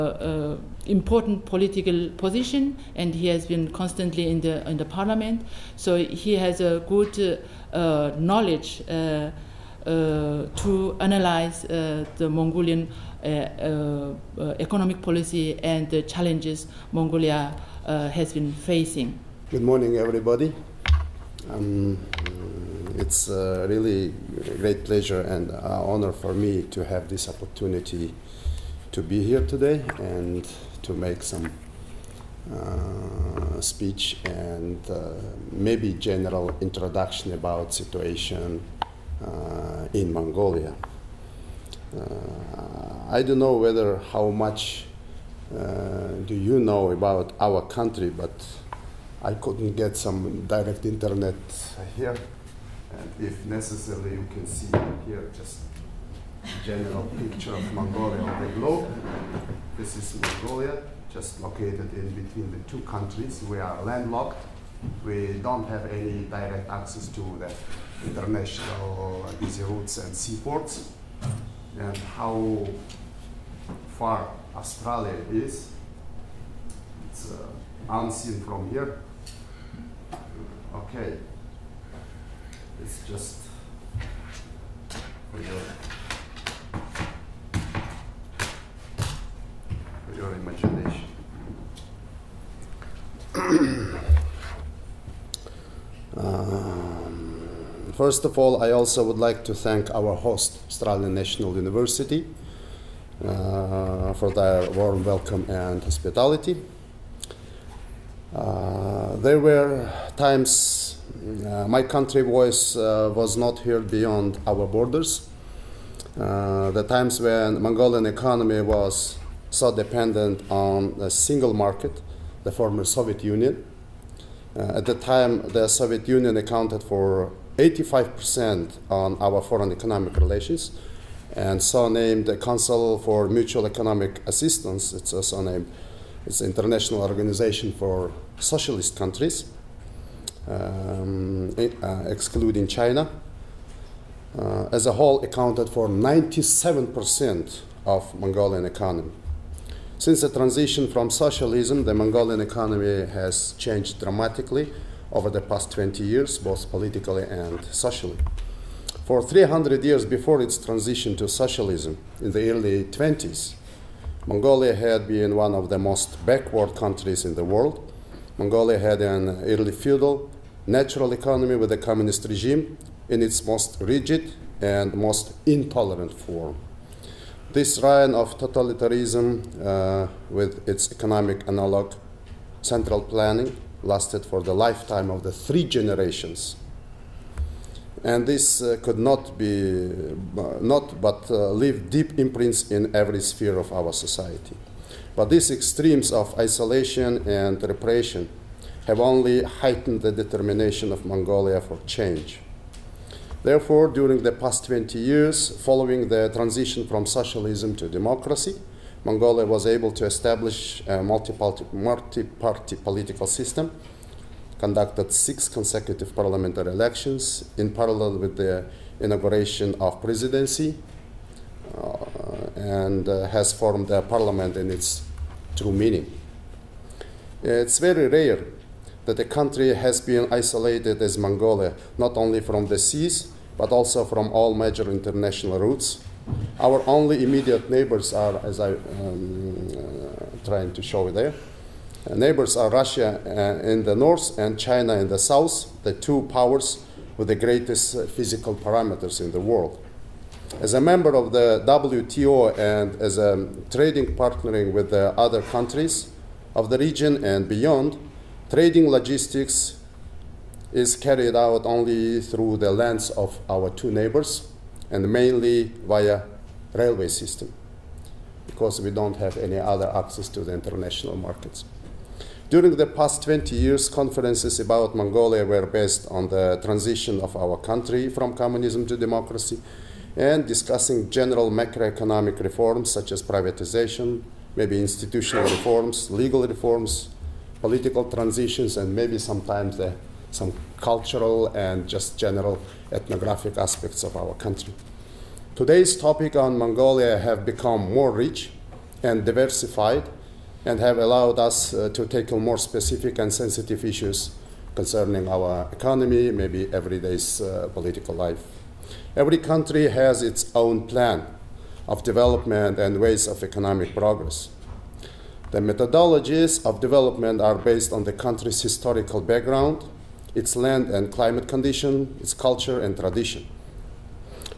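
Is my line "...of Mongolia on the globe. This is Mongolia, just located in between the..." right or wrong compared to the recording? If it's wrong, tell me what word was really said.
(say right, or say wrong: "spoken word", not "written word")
right.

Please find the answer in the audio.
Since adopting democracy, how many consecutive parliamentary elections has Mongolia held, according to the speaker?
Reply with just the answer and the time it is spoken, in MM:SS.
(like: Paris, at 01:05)
6, at 03:35.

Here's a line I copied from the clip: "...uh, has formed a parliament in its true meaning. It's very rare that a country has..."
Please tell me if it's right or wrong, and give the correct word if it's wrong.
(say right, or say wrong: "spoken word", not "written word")
right.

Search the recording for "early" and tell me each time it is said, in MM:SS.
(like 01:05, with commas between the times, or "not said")
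02:42, 02:49.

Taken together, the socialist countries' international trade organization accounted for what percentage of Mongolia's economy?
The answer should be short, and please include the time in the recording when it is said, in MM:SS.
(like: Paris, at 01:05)
97%, at 02:25.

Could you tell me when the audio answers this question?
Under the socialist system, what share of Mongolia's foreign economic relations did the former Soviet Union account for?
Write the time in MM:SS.
02:07.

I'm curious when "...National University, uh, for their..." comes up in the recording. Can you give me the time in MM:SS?
01:41.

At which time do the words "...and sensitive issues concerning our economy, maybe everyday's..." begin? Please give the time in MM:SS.
05:03.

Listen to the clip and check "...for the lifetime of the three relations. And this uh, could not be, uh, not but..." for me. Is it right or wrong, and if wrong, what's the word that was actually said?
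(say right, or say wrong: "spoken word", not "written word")
wrong: "generations", not "relations".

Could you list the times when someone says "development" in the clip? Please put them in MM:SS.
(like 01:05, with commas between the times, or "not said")
05:12, 05:16.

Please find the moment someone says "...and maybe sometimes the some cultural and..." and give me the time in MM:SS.
04:48.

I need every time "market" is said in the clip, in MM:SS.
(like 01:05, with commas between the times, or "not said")
02:01, 04:31.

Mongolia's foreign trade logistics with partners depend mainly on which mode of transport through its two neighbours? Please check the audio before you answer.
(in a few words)
railway.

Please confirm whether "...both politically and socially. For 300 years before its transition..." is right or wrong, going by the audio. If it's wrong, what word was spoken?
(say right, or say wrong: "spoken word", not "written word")
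right.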